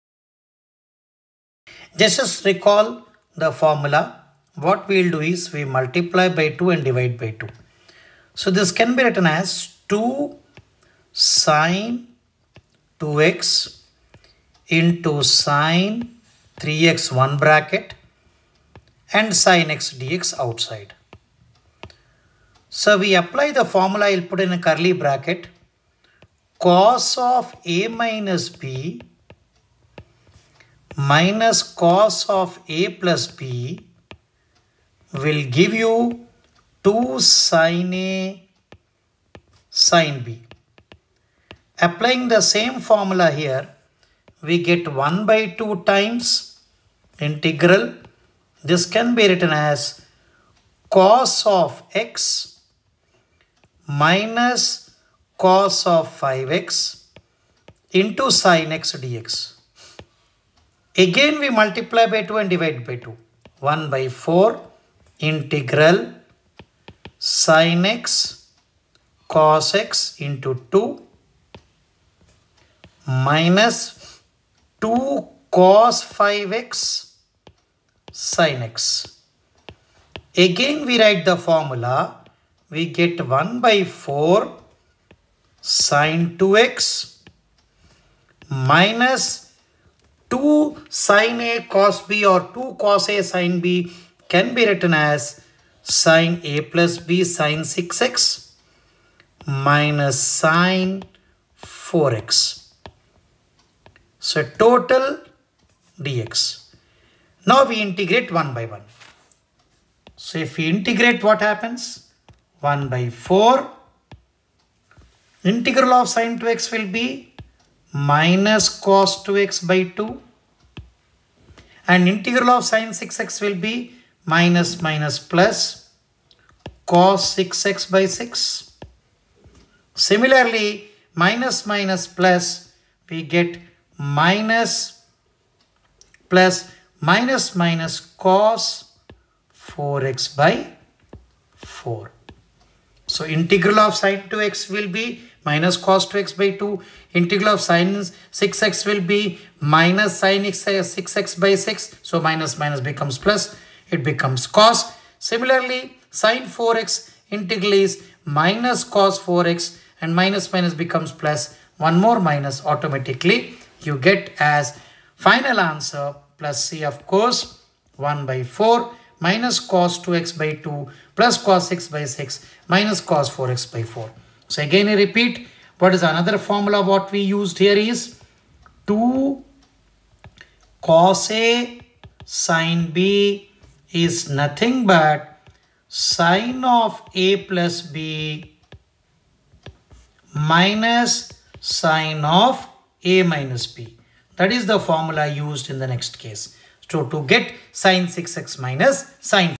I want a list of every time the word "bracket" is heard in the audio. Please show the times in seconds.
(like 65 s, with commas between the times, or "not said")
17 s, 24 s.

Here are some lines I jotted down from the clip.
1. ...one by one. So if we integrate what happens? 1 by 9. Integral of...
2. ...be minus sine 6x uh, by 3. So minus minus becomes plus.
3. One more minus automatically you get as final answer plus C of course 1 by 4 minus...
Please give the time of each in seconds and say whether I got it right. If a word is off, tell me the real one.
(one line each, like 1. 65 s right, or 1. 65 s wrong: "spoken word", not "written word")
1. 108 s wrong: "4", not "9"
2. 149 s wrong: "6", not "3"
3. 161 s right.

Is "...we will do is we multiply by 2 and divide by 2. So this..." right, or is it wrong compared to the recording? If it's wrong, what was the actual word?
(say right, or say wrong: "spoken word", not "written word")
right.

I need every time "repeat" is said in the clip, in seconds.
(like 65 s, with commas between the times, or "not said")
174 s.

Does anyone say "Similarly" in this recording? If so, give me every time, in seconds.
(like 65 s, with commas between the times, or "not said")
129 s, 155 s.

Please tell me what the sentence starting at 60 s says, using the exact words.
Again we multiply by 2 and divide by 2.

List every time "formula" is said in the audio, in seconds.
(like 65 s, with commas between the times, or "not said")
3 s, 23 s, 42 s, 81 s, 176 s, 194 s.